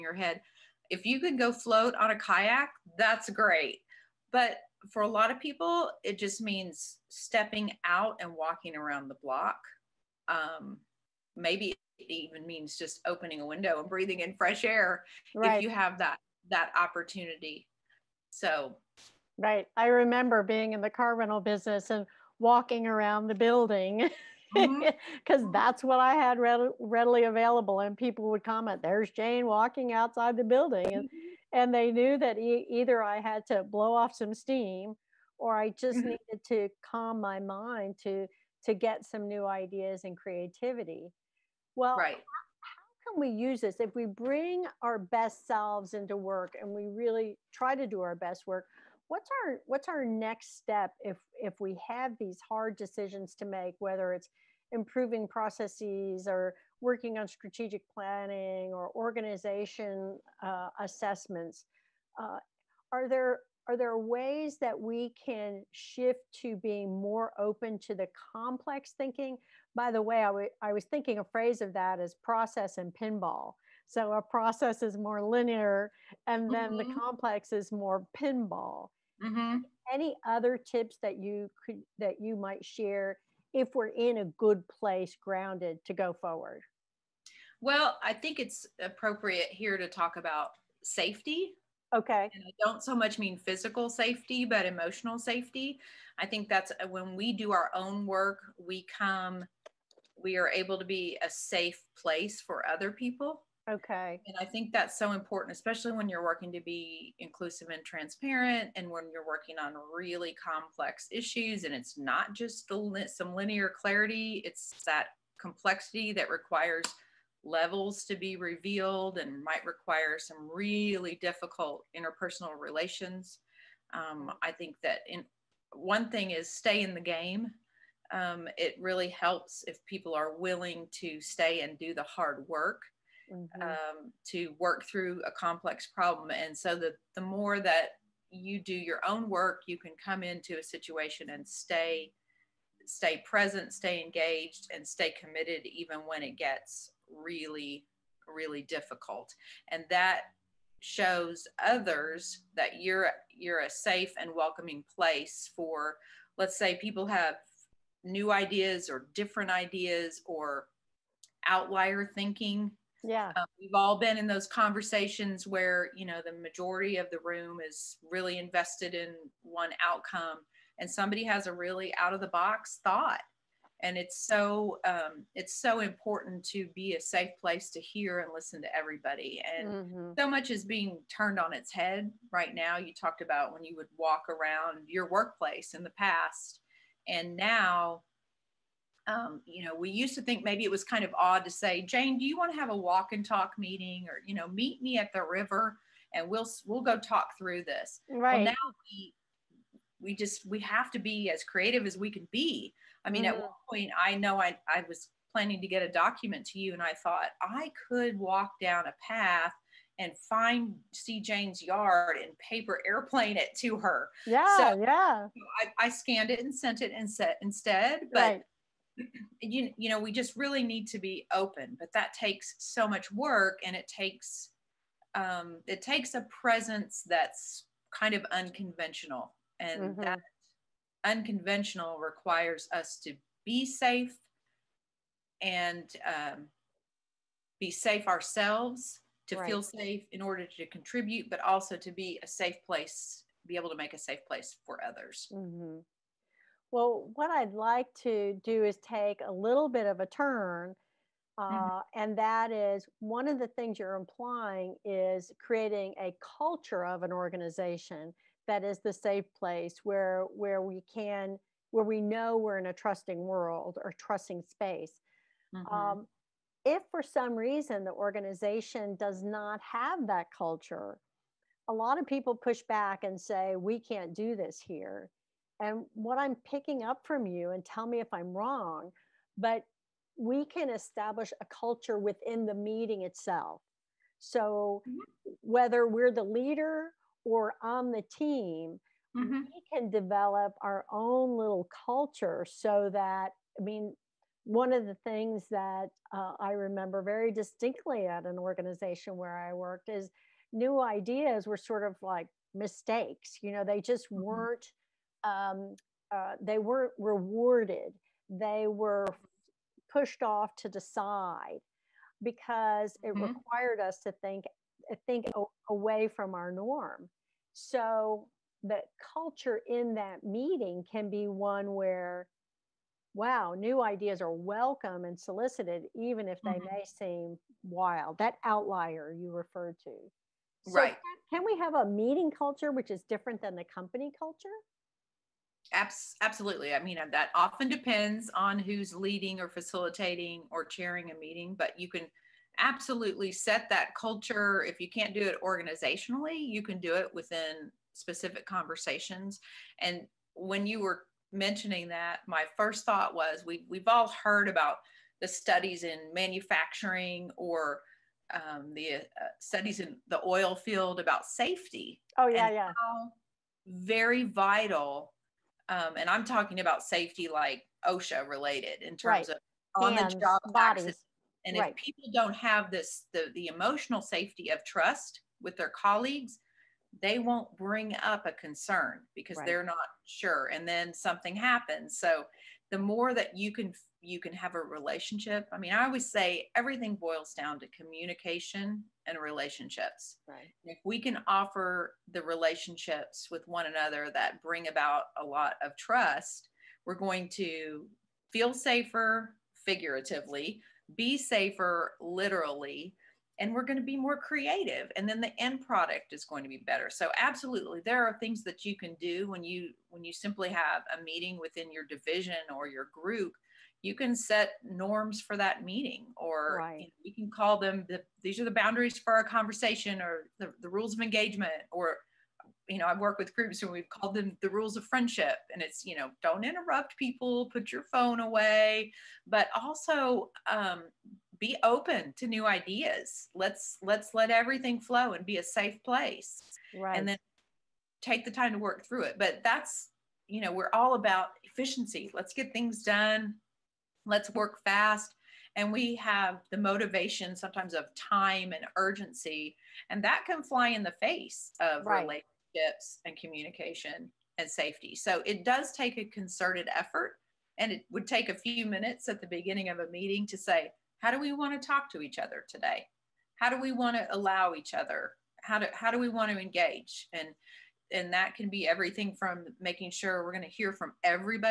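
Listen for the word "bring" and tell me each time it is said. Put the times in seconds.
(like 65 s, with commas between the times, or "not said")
44 s, 377 s, 394 s.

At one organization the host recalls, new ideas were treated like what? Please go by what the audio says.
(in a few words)
mistakes.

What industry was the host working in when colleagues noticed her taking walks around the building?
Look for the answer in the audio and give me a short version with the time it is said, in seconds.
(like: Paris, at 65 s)
car rental business, at 20 s.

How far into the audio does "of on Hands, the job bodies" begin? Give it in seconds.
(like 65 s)
369 s.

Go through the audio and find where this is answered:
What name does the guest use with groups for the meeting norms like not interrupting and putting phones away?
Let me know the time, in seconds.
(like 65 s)
424 s.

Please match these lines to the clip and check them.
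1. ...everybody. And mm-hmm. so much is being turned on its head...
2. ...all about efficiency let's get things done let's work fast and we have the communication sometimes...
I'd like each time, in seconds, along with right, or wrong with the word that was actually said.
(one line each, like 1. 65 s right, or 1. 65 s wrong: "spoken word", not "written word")
1. 178 s right
2. 440 s wrong: "motivation", not "communication".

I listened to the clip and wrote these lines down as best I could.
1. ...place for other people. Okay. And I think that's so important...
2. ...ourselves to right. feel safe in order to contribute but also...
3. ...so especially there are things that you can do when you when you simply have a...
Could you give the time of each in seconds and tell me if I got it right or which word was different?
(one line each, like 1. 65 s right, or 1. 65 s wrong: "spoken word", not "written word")
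1. 101 s right
2. 238 s right
3. 406 s wrong: "absolutely", not "especially".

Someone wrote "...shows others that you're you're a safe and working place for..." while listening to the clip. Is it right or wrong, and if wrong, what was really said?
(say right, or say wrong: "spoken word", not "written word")
wrong: "welcoming", not "working".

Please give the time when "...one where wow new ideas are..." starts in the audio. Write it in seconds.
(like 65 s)
321 s.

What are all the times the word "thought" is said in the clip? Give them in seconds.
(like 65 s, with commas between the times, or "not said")
172 s, 207 s, 352 s.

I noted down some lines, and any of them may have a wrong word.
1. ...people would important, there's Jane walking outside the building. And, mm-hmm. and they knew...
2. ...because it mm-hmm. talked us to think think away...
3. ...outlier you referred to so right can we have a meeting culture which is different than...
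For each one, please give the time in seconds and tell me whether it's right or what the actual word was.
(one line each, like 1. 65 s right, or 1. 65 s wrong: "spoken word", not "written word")
1. 27 s wrong: "comment", not "important"
2. 312 s wrong: "required", not "talked"
3. 328 s right.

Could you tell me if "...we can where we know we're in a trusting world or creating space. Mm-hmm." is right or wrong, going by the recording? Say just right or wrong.
wrong.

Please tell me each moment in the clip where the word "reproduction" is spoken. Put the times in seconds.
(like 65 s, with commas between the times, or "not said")
not said.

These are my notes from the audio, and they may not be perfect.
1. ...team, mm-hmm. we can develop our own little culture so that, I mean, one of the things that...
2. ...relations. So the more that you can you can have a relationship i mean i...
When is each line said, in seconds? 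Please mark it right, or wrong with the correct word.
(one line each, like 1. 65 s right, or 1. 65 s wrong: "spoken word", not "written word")
1. 288 s right
2. 381 s wrong: "happens", not "relations".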